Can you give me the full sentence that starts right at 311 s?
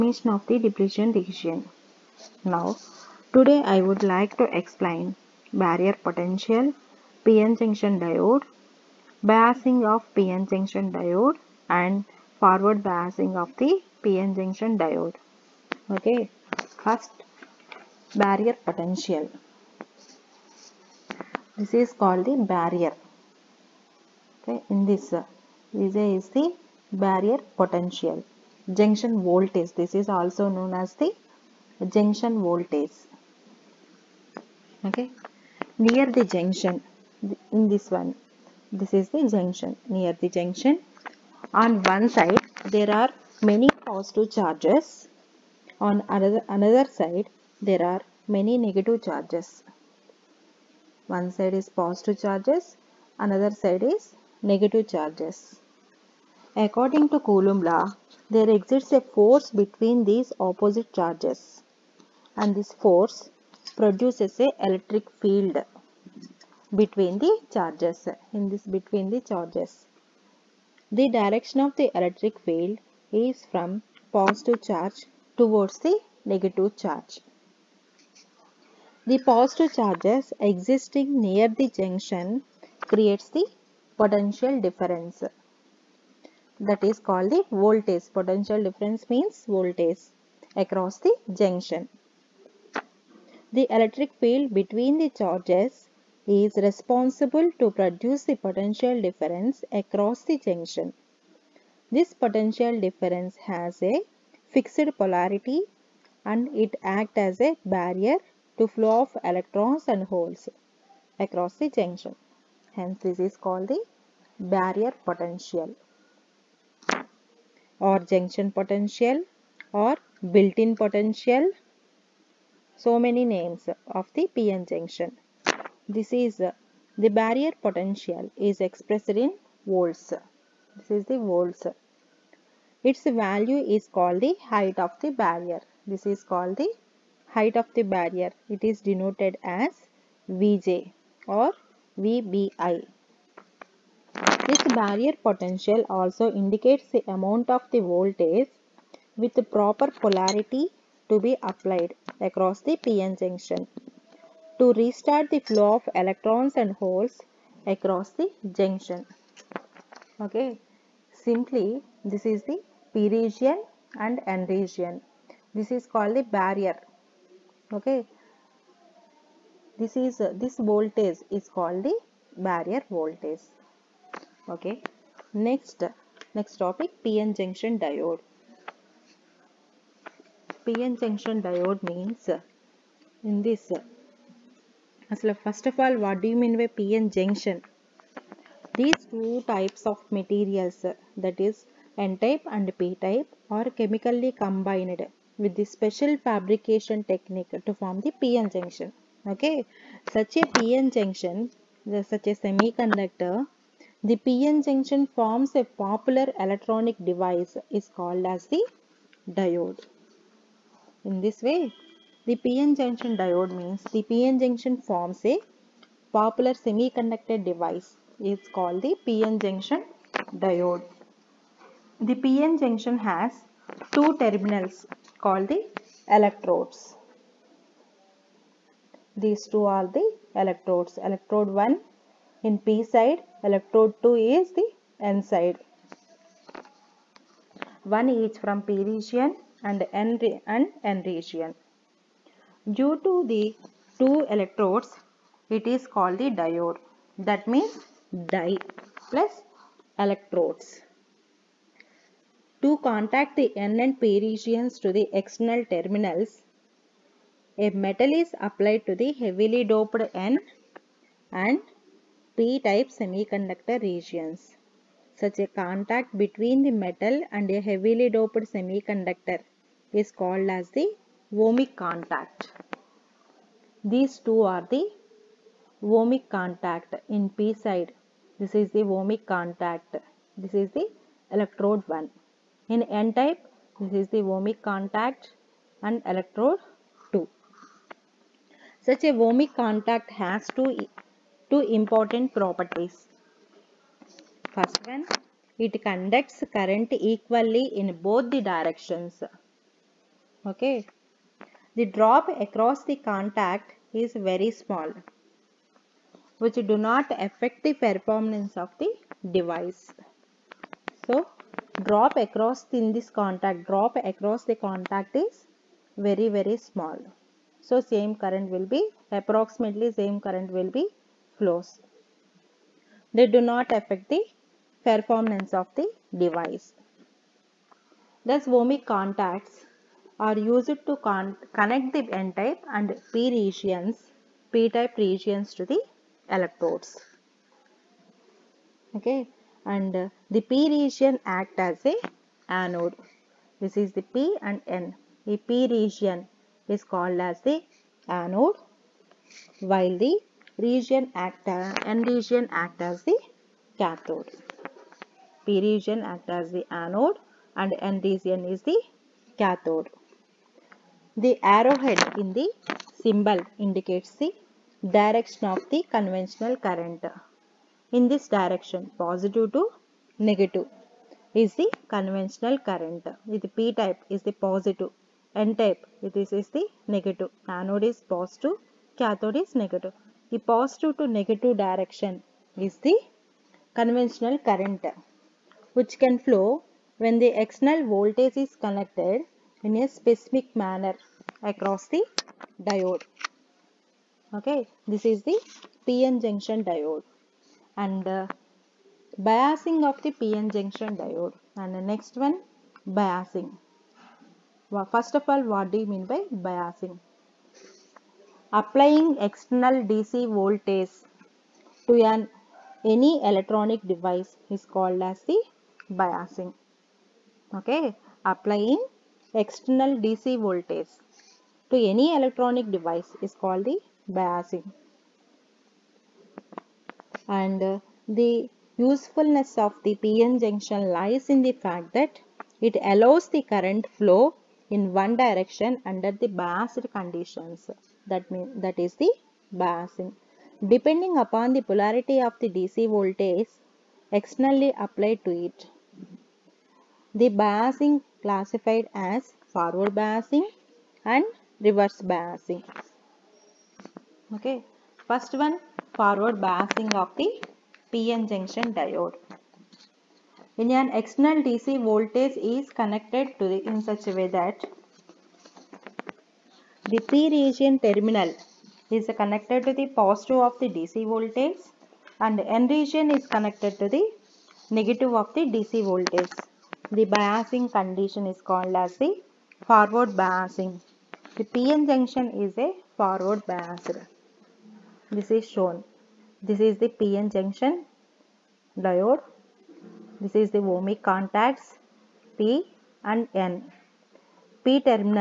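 So drop across in this contact, drop across the contact is very very small.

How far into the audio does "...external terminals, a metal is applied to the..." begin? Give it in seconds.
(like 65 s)
255 s.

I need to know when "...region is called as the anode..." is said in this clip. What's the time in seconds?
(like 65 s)
345 s.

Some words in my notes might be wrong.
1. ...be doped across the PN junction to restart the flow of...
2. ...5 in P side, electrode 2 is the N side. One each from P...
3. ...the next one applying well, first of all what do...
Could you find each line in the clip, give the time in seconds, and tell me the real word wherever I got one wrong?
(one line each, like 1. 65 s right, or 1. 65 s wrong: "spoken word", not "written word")
1. 151 s wrong: "applied", not "doped"
2. 231 s wrong: "1", not "5"
3. 401 s wrong: "biasing", not "applying".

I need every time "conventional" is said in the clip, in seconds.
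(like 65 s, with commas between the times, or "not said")
365 s, 371 s, 383 s.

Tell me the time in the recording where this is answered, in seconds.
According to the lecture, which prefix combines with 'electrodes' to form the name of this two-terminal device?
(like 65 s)
248 s.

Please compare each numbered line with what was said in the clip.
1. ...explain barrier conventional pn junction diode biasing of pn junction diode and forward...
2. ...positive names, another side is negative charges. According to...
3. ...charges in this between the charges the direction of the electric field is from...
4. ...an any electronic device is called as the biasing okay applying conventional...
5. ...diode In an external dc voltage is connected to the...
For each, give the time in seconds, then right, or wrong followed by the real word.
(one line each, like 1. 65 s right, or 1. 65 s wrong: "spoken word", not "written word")
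1. 4 s wrong: "potential", not "conventional"
2. 51 s wrong: "charges", not "names"
3. 67 s right
4. 412 s wrong: "external", not "conventional"
5. 458 s right.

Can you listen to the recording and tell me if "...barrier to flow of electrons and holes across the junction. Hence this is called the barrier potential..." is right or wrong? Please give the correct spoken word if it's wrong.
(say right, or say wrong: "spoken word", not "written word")
right.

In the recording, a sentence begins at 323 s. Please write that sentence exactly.
They do not affect the performance of the device.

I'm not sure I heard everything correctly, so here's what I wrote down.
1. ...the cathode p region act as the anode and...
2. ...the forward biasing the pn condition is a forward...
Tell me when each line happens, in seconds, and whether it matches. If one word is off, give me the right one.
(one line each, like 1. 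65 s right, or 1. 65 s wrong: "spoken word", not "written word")
1. 353 s right
2. 479 s wrong: "junction", not "condition".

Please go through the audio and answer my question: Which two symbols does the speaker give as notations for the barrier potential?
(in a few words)
Vj or VBI.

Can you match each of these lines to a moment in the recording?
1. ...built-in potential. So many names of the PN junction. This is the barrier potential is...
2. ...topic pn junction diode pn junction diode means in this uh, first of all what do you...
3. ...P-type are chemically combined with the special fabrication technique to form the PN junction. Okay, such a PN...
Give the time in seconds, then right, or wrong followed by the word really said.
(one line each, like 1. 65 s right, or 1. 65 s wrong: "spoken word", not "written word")
1. 120 s right
2. 176 s right
3. 192 s right.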